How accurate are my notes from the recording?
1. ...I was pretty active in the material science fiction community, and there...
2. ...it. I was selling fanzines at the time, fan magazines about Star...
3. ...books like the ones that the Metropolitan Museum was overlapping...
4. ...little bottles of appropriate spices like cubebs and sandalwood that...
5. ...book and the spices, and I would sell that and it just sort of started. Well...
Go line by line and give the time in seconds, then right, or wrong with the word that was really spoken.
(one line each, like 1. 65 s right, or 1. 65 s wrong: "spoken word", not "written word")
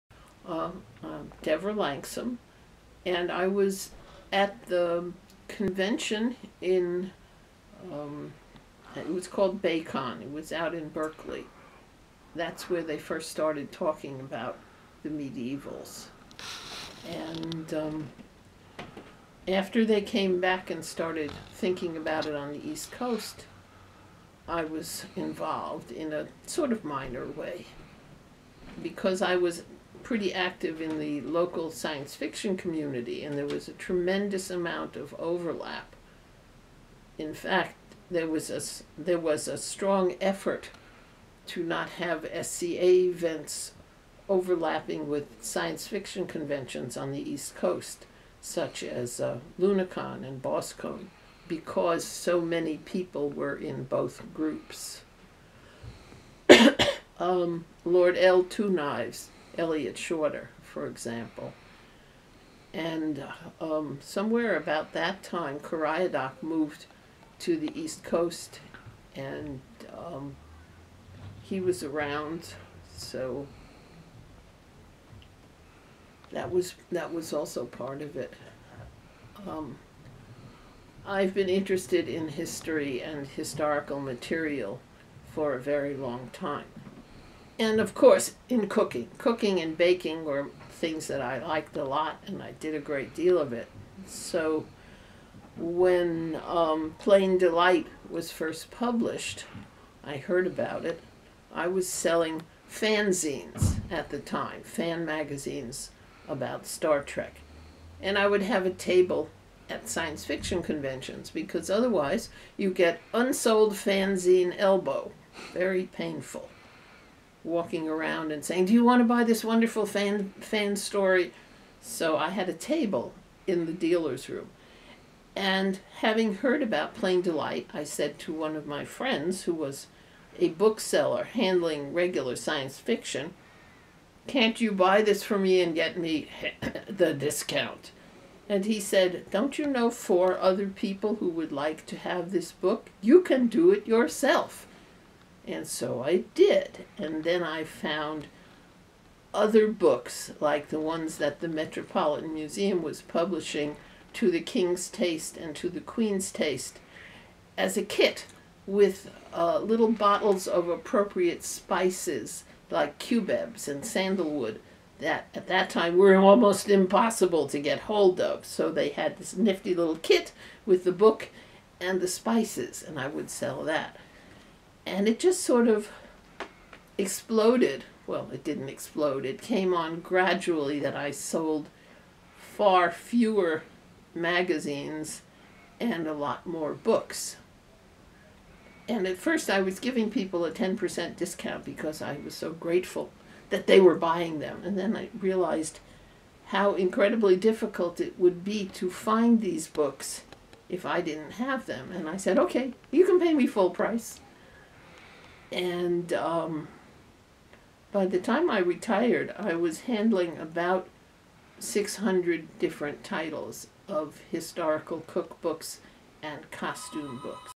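1. 29 s wrong: "local", not "material"
2. 100 s right
3. 149 s wrong: "publishing", not "overlapping"
4. 159 s right
5. 170 s wrong: "exploded", not "started".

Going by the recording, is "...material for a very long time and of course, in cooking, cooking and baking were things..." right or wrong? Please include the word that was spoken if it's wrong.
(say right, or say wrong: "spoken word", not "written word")
right.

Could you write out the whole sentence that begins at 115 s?
Very painful walking around and saying, Do you want to buy this wonderful fan, fan story?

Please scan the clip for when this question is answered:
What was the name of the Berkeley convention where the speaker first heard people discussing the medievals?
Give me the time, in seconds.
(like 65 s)
9 s.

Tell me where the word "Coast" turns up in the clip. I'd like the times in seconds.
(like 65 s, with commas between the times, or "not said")
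22 s, 47 s, 68 s.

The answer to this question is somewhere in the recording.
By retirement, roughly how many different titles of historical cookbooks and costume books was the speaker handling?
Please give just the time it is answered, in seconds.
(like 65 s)
211 s.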